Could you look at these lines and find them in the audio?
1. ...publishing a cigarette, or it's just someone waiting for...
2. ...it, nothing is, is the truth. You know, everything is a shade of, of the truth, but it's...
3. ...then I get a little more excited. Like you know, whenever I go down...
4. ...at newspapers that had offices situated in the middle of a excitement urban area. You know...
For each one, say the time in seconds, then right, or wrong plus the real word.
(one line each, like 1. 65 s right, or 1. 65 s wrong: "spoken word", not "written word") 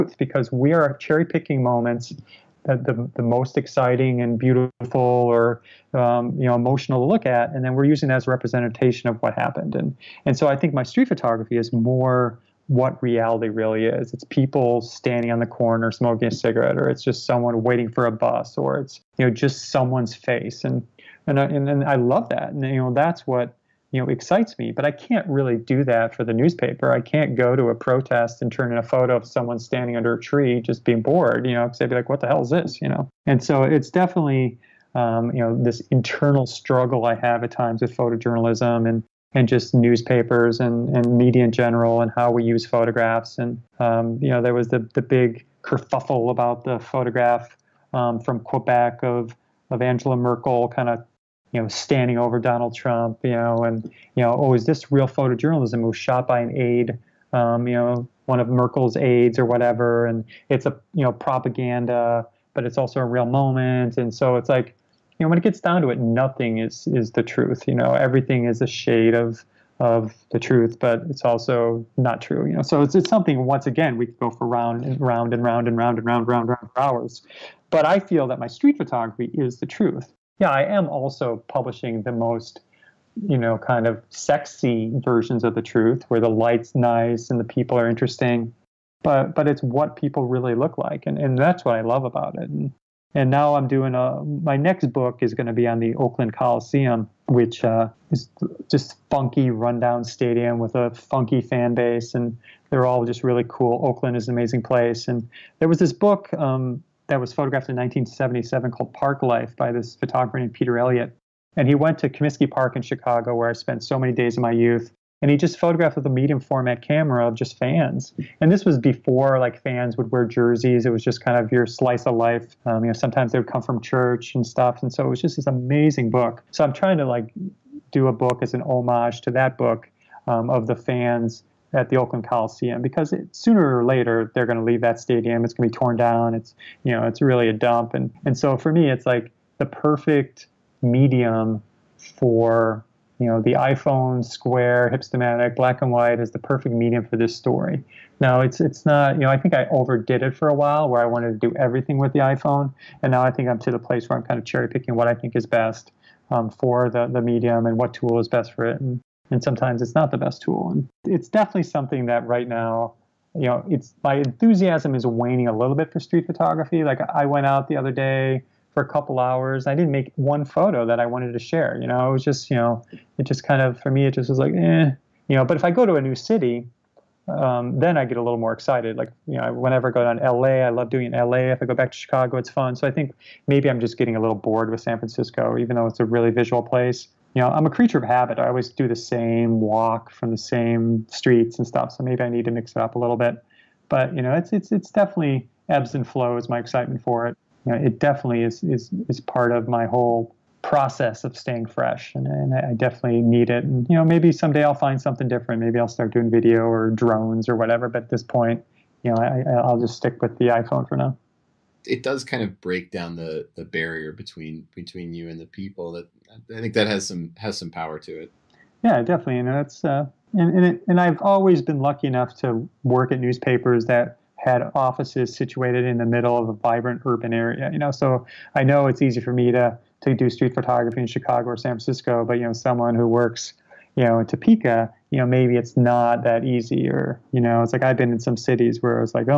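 1. 15 s wrong: "smoking", not "publishing"
2. 65 s right
3. 177 s right
4. 223 s wrong: "vibrant", not "excitement".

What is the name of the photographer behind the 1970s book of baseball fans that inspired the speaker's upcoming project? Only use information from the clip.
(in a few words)
Peter Elliott.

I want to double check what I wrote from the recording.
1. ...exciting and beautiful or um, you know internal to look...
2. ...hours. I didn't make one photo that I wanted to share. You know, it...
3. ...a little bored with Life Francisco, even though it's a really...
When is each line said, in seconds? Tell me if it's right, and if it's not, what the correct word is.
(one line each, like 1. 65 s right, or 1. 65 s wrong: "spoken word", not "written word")
1. 3 s wrong: "emotional", not "internal"
2. 169 s right
3. 184 s wrong: "San", not "Life".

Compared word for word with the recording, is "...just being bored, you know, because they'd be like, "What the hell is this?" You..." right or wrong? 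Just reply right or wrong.
right.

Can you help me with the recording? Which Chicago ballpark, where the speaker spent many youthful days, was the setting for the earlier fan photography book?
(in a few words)
Comiskey Park.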